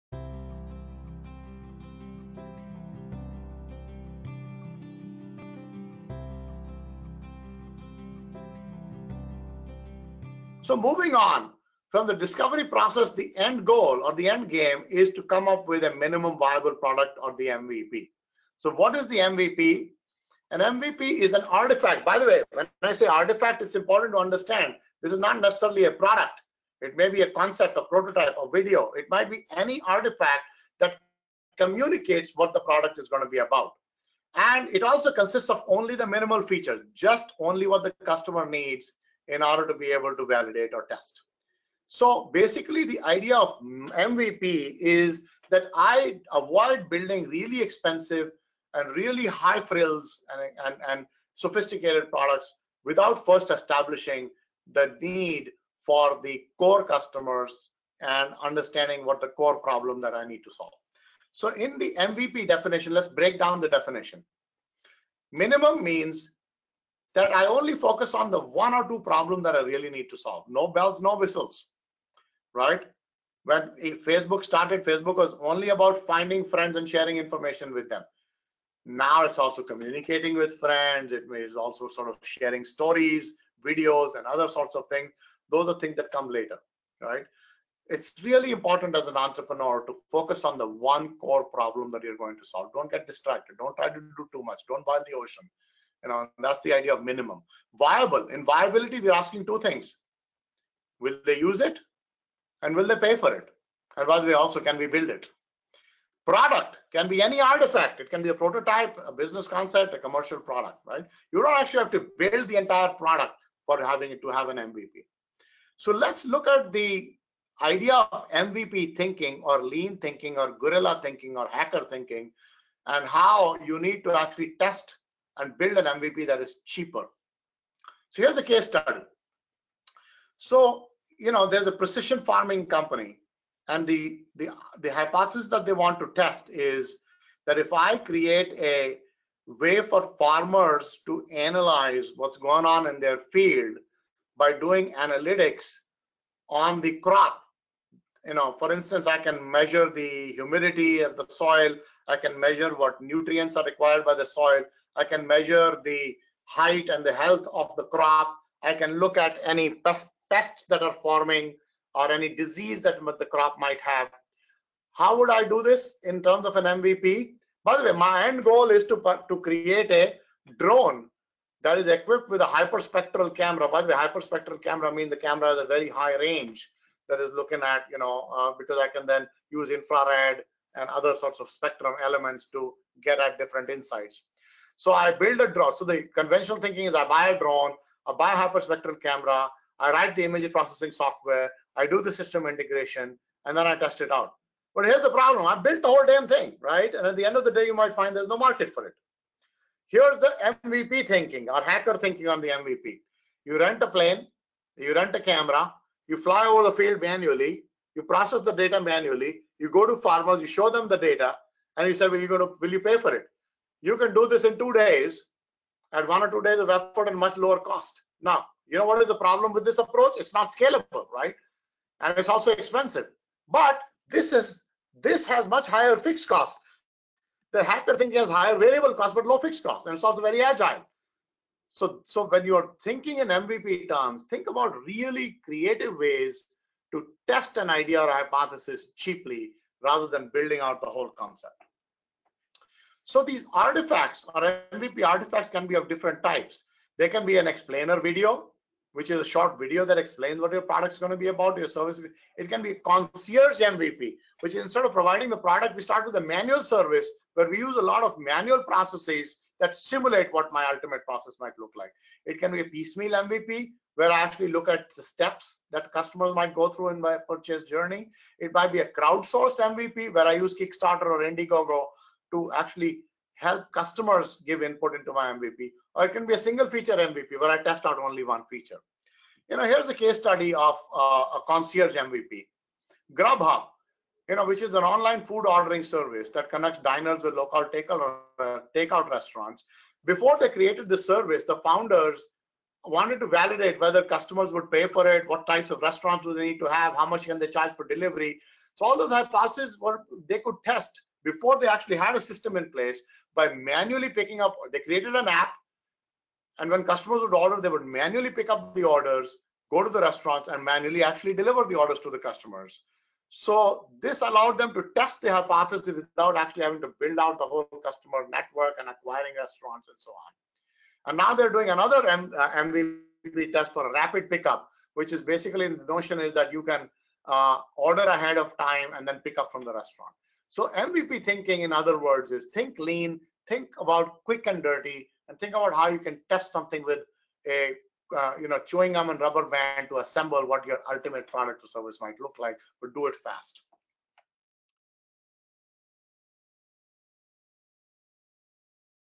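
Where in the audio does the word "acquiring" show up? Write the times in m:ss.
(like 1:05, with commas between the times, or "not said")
5:18.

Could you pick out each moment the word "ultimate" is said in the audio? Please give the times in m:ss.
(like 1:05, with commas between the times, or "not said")
4:20, 5:40.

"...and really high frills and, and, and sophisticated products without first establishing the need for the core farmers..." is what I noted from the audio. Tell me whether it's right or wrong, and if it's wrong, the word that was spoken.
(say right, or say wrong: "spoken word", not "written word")
wrong: "customers", not "farmers".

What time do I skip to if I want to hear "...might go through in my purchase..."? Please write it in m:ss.
4:26.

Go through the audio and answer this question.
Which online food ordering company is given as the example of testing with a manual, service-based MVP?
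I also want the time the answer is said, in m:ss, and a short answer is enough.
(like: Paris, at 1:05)
Grubhub, at 4:43.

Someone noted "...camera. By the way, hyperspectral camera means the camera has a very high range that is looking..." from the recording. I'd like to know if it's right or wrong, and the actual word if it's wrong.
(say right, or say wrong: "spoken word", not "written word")
right.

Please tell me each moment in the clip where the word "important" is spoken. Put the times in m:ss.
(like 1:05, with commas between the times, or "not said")
0:23, 1:28.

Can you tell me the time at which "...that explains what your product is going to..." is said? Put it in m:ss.
4:09.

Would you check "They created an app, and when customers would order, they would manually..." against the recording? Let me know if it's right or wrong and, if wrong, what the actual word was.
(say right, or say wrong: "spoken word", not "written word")
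right.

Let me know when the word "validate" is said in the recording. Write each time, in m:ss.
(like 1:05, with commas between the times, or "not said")
0:40, 4:53.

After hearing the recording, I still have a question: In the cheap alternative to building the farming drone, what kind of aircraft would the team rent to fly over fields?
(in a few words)
A plane.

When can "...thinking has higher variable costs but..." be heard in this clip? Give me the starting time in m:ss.
3:47.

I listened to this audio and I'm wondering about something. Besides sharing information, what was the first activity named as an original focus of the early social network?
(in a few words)
Finding friends.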